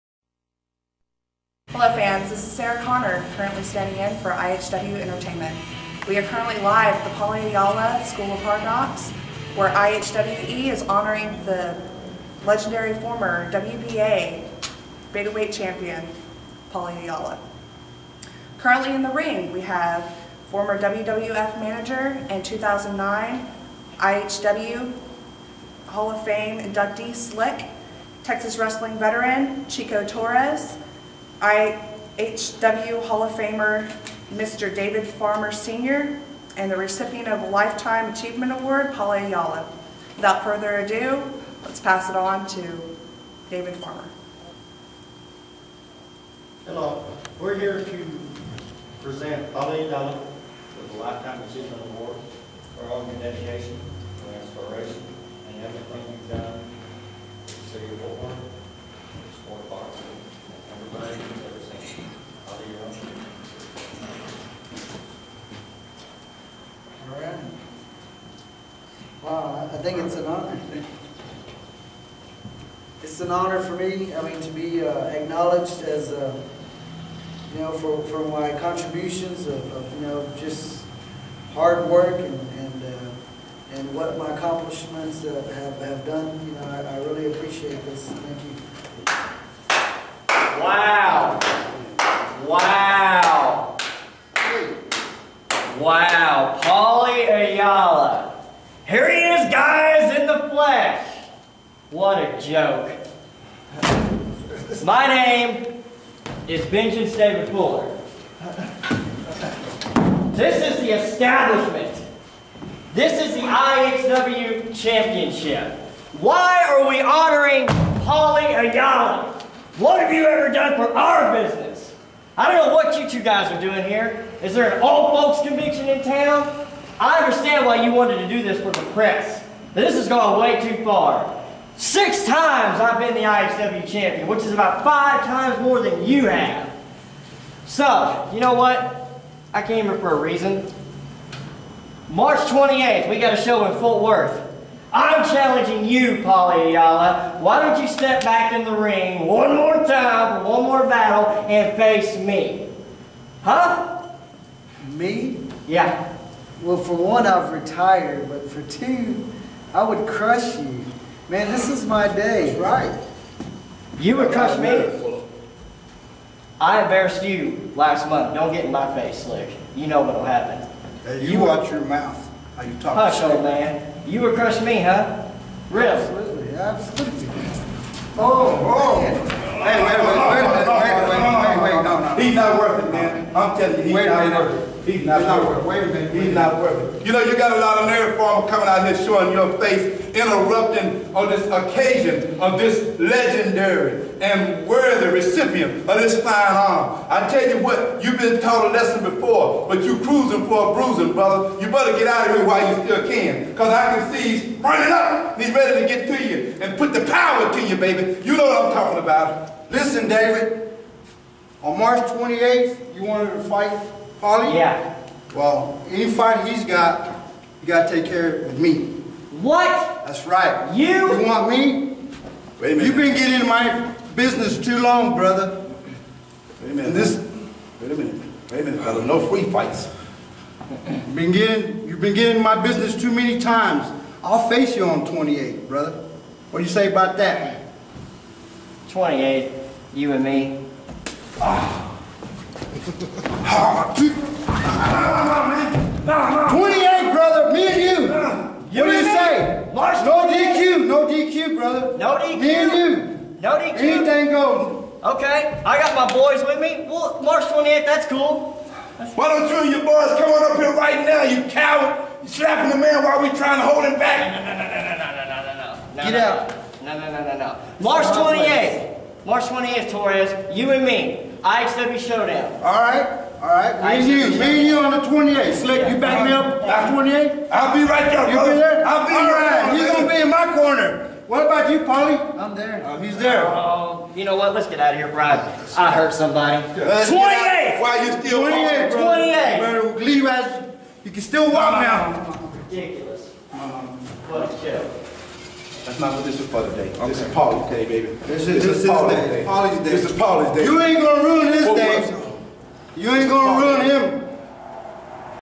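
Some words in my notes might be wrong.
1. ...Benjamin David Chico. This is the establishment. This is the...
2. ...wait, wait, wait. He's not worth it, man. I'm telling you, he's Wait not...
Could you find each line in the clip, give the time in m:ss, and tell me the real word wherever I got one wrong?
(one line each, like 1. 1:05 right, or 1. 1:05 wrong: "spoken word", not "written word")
1. 1:46 wrong: "Fuller", not "Chico"
2. 3:01 right.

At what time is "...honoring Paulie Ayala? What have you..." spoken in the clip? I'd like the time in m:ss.
1:57.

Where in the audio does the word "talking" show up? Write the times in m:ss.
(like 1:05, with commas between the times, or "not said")
2:52, 3:28.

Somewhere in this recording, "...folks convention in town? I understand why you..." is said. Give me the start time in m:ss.
2:05.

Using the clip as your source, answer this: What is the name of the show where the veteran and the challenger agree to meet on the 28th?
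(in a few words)
IXW Showdown.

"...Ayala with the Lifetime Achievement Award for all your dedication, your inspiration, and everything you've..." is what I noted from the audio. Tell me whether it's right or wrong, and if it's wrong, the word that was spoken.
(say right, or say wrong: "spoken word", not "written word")
right.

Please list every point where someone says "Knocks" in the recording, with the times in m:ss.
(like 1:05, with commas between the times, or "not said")
0:08.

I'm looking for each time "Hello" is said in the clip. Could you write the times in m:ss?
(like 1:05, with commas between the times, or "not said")
0:01, 0:46.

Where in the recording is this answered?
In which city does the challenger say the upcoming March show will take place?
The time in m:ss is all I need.
2:23.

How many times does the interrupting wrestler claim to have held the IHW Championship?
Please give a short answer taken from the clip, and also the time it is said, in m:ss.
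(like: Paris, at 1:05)
6, at 2:11.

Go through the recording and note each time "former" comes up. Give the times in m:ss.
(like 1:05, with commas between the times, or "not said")
0:12, 0:20.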